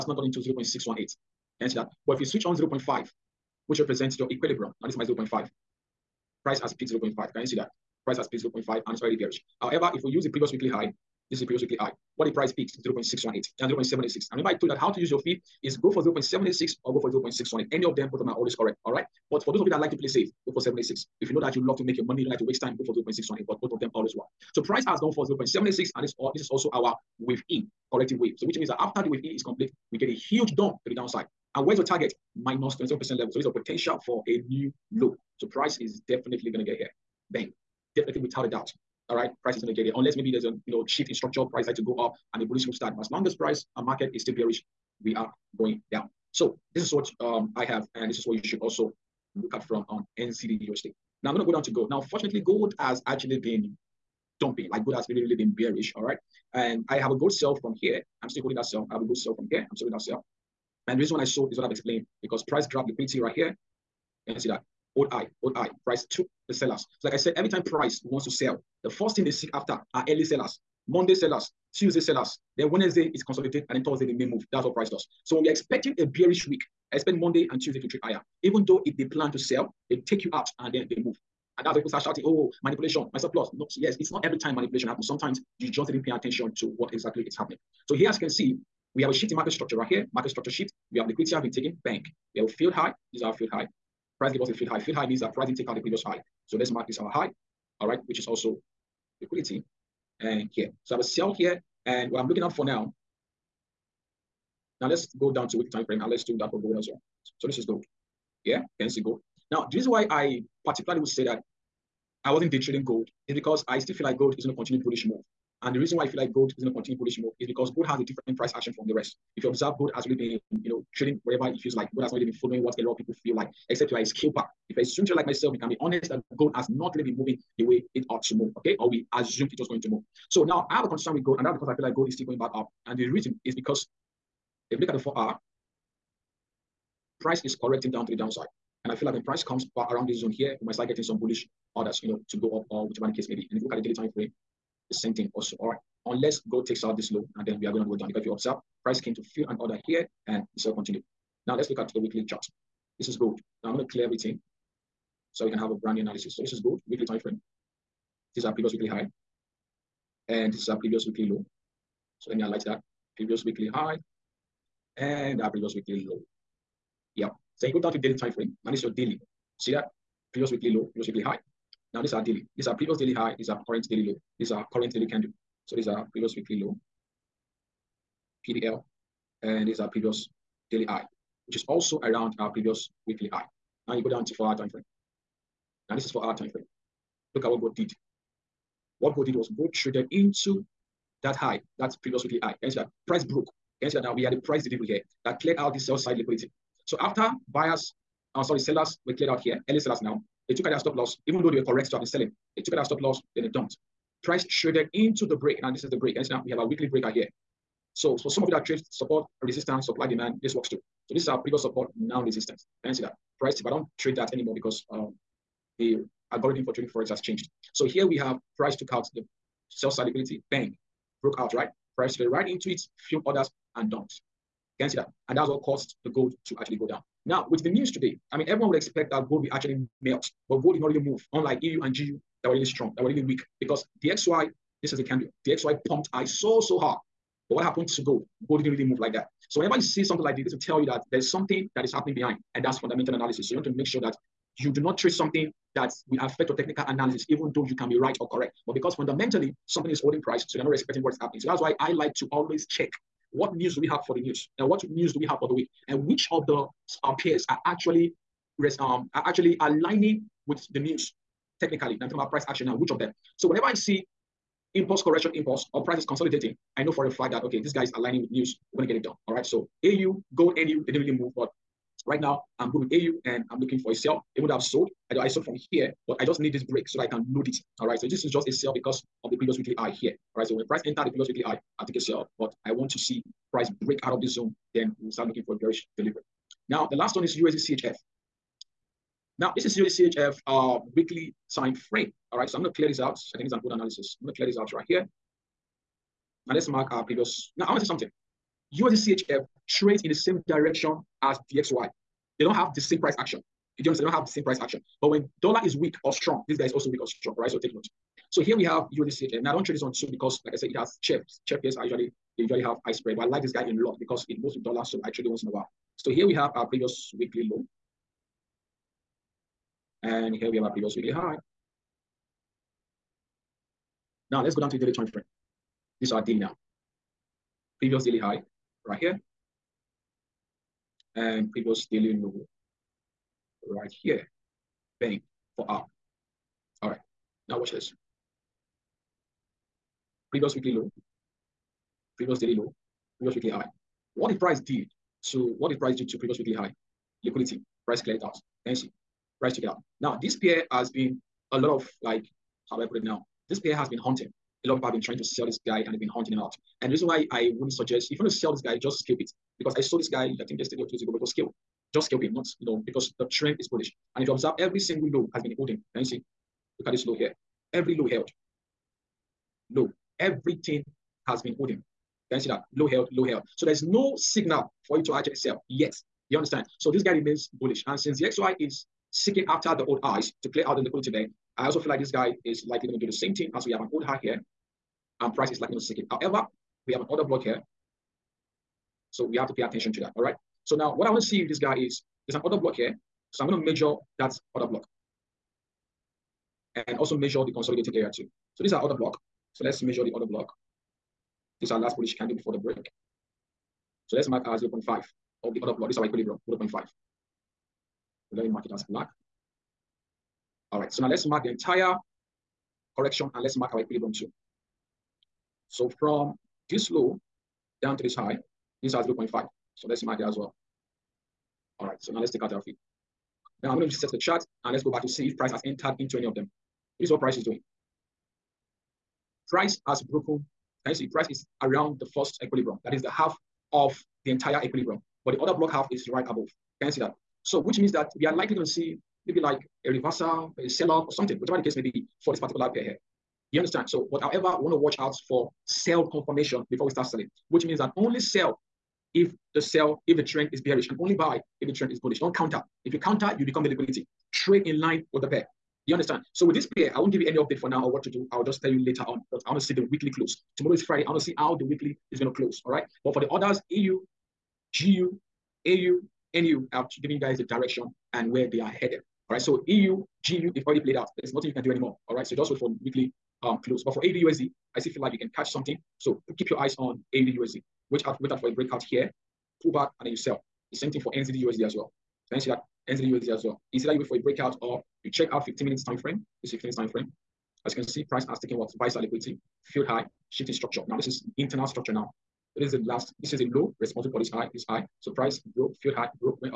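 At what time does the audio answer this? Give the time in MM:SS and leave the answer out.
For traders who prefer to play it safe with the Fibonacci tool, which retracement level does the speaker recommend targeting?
00:20.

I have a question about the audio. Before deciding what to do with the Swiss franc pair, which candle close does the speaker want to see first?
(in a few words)
Weekly close.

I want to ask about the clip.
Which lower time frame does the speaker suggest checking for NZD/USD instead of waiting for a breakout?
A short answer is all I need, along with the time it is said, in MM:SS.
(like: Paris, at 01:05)
15 minutes, at 08:05.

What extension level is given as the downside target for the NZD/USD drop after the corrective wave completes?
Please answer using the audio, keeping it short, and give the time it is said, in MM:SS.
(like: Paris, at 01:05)
-27%, at 00:32.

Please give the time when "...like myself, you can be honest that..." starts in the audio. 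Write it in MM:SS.
02:05.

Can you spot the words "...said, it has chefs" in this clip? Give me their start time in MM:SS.
05:10.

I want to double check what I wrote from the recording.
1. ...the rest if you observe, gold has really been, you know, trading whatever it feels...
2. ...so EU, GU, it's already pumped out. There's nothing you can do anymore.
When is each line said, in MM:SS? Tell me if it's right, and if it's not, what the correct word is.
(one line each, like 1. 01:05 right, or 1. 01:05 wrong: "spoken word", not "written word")
1. 01:58 right
2. 07:49 wrong: "played", not "pumped".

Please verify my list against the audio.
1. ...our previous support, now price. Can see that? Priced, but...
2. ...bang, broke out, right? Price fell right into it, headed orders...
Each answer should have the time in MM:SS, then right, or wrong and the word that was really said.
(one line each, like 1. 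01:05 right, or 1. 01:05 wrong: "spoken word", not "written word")
1. 03:31 wrong: "resistance", not "price"
2. 03:40 wrong: "filled", not "headed".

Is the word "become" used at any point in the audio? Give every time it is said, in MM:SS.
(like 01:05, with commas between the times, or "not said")
07:33.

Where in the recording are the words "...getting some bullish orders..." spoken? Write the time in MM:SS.
02:20.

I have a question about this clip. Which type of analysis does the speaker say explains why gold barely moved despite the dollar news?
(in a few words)
Fundamental analysis.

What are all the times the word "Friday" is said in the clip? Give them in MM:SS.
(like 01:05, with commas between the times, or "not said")
07:40.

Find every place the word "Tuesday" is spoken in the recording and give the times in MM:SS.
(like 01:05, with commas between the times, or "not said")
01:11, 01:17.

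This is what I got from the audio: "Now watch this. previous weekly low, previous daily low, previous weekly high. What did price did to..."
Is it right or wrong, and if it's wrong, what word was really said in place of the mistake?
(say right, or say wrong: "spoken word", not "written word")
right.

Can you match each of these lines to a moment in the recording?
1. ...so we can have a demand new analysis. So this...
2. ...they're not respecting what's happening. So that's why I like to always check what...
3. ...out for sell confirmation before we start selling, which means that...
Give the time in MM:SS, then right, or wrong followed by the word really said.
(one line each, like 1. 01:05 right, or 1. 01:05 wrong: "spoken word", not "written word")
1. 02:35 wrong: "brand", not "demand"
2. 04:10 right
3. 07:24 right.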